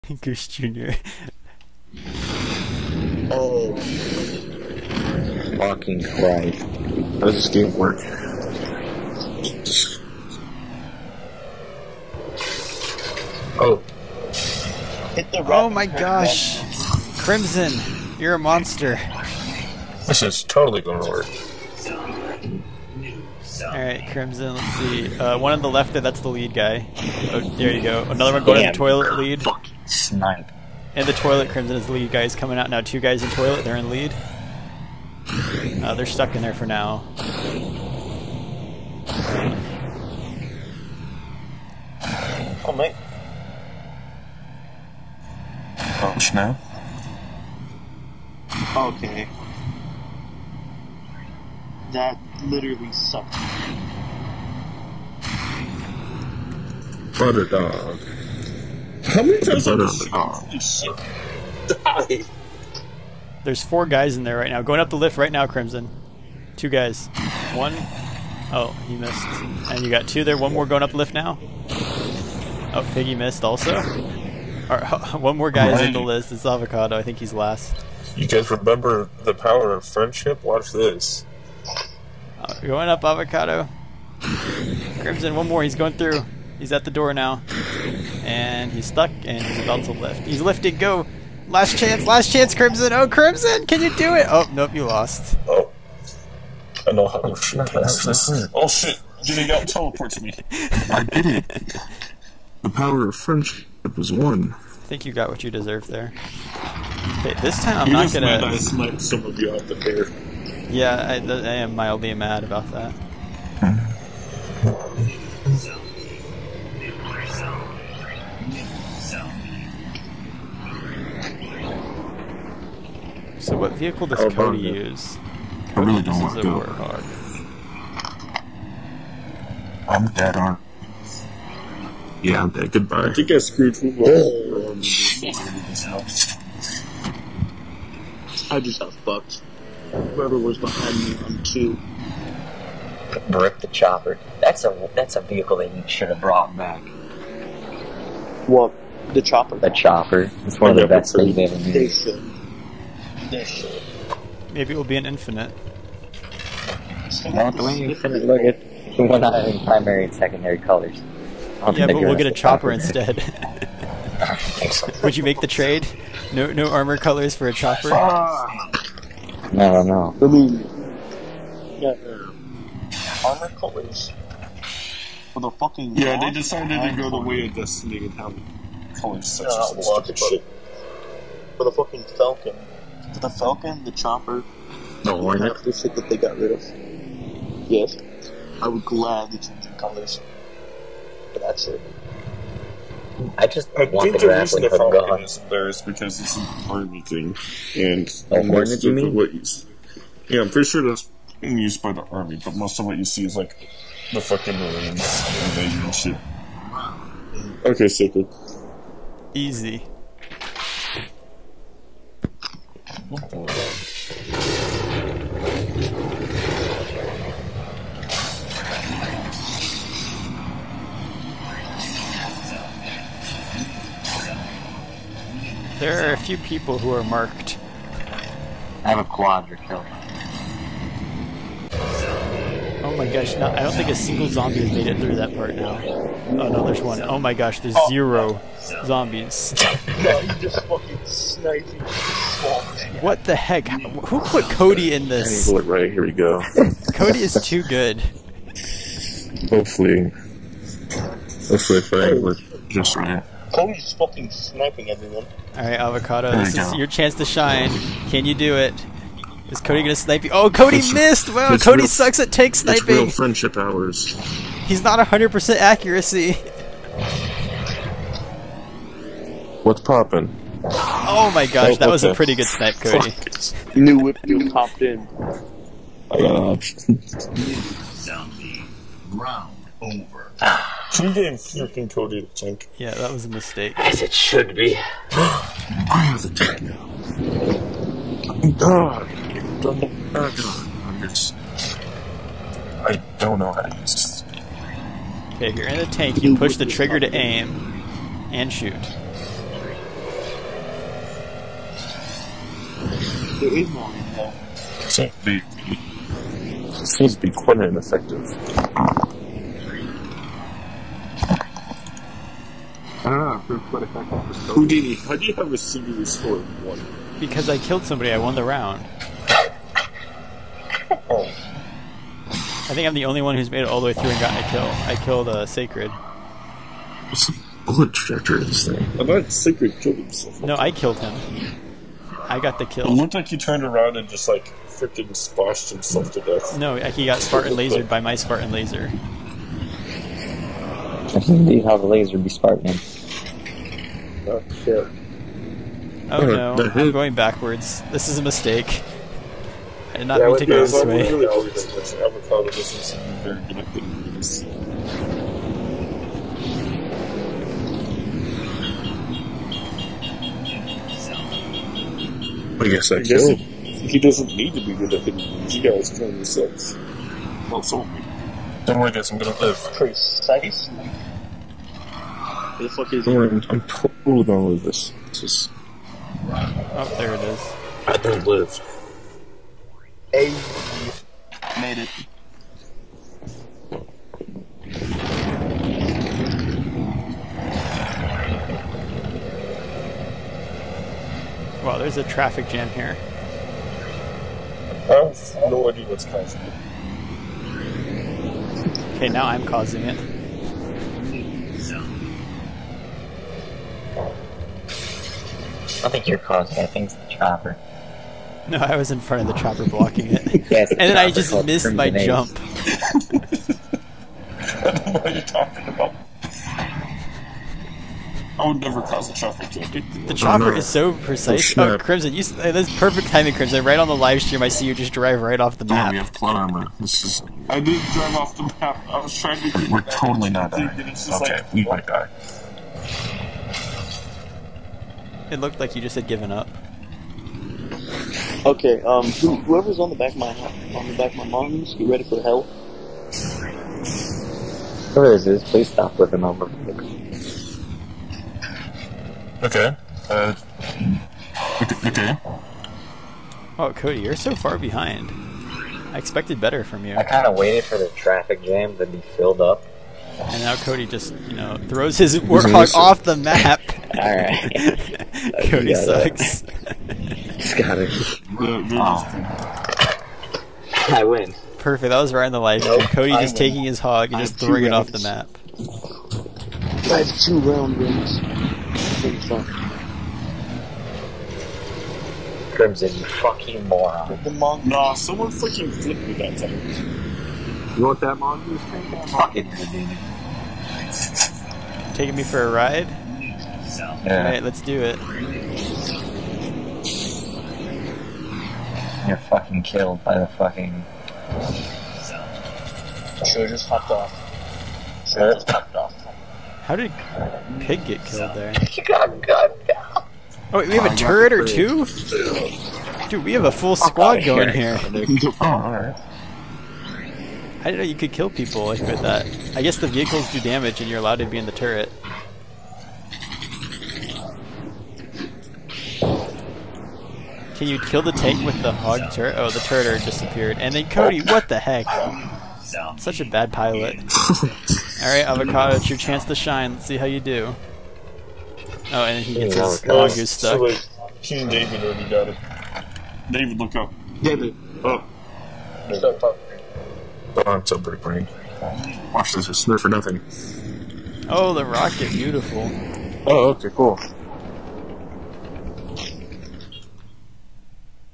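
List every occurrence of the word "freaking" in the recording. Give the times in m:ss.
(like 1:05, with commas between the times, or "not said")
4:41, 5:34.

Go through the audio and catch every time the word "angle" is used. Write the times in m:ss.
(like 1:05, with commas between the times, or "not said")
4:05, 4:12.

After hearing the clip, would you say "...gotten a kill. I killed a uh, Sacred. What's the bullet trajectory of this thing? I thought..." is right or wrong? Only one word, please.
right.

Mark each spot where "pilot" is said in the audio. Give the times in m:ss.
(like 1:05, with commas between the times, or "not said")
8:53.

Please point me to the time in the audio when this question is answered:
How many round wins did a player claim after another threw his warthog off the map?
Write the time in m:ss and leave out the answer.
7:57.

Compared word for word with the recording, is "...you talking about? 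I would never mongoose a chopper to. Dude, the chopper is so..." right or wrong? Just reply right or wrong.
wrong.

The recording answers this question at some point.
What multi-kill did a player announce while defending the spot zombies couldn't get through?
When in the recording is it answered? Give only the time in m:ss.
3:49.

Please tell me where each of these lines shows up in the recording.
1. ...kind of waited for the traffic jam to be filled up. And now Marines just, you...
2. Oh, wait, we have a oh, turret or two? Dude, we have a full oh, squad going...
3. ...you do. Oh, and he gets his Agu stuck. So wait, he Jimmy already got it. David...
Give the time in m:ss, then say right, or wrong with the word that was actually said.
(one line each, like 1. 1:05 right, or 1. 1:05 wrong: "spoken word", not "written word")
1. 7:37 wrong: "Cody", not "Marines"
2. 8:30 right
3. 8:57 wrong: "David", not "Jimmy".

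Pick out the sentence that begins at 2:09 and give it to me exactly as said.
I'm dead, aren't Yeah, I'm dead.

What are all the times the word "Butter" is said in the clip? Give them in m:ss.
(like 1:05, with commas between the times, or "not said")
0:57.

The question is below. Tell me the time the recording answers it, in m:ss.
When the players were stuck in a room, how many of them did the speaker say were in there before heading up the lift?
1:03.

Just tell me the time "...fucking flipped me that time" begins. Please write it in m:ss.
8:05.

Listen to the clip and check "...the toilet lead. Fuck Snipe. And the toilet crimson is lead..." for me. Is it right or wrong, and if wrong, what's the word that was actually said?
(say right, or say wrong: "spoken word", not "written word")
right.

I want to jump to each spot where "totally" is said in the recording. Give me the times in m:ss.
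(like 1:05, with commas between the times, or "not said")
0:20, 6:13, 7:09.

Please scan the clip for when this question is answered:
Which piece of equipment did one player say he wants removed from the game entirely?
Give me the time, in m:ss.
3:14.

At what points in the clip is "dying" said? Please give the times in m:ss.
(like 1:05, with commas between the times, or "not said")
7:10.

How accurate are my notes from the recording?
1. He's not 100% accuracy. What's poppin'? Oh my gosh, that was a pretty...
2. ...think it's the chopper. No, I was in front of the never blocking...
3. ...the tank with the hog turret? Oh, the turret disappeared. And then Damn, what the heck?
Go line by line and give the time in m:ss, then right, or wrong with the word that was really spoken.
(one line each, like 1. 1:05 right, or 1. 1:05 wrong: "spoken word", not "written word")
1. 4:24 right
2. 6:46 wrong: "chopper", not "never"
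3. 8:48 wrong: "Cody", not "Damn".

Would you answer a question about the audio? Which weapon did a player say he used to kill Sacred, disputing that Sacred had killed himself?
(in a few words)
Spartan laser.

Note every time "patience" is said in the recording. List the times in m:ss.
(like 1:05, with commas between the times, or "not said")
not said.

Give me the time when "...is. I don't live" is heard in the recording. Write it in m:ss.
6:17.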